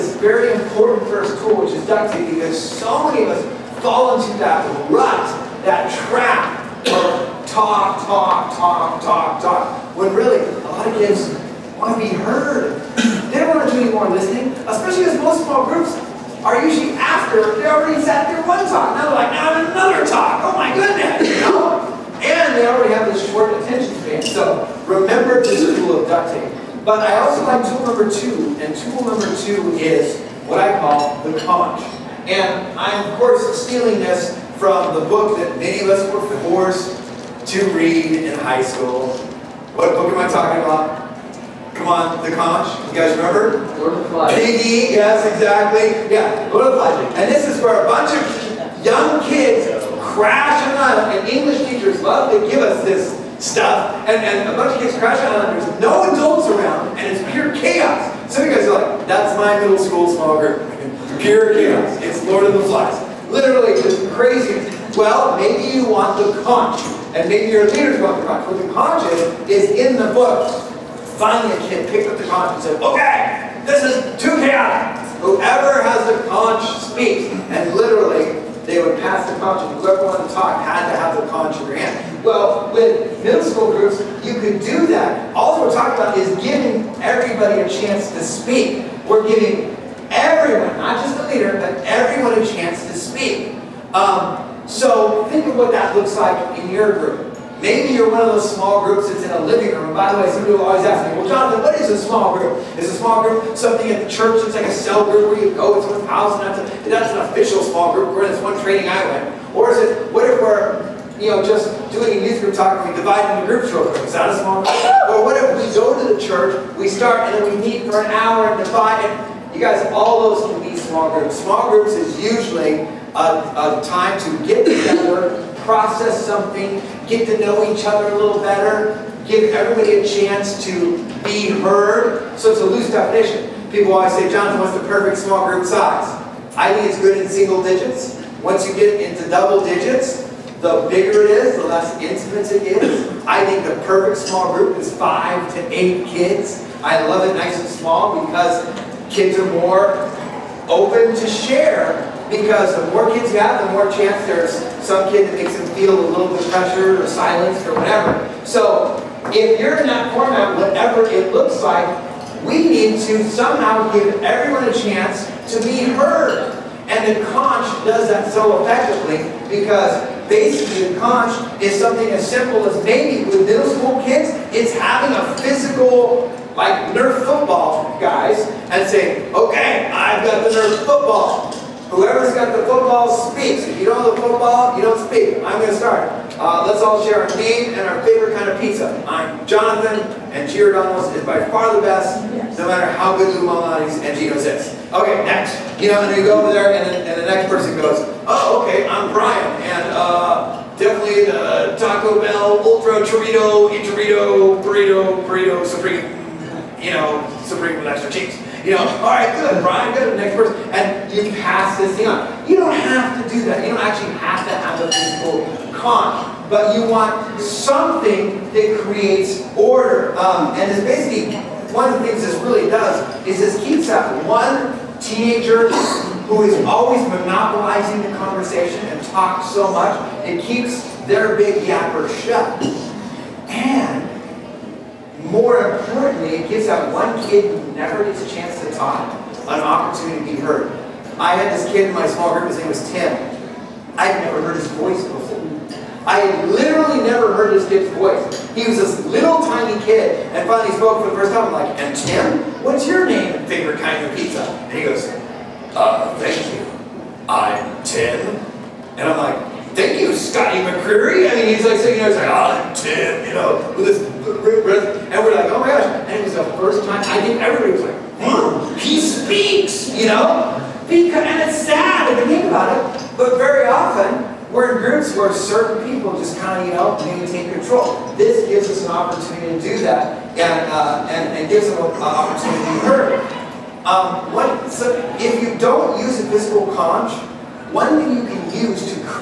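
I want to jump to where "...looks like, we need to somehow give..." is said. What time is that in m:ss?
2:41.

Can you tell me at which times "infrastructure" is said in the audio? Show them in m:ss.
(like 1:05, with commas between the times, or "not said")
not said.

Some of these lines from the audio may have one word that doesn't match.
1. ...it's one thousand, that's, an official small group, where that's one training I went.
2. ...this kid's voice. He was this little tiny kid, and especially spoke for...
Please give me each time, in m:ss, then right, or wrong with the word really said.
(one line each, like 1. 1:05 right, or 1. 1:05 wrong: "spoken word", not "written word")
1. 1:45 right
2. 4:07 wrong: "finally", not "especially".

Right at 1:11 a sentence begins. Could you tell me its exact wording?
Finally, a kid picked up the conch and said, okay, this is too chaotic.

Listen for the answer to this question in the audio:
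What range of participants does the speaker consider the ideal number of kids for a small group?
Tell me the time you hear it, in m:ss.
2:24.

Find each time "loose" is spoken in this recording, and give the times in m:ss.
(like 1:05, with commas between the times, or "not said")
2:12.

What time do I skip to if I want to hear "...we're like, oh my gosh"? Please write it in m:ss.
4:25.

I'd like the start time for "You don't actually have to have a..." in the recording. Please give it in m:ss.
3:33.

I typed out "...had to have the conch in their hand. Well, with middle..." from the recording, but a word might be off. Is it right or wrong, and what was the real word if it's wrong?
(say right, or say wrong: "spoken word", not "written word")
right.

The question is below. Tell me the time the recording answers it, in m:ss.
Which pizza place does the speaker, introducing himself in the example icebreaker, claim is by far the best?
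3:10.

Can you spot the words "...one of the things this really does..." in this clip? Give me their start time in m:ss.
3:41.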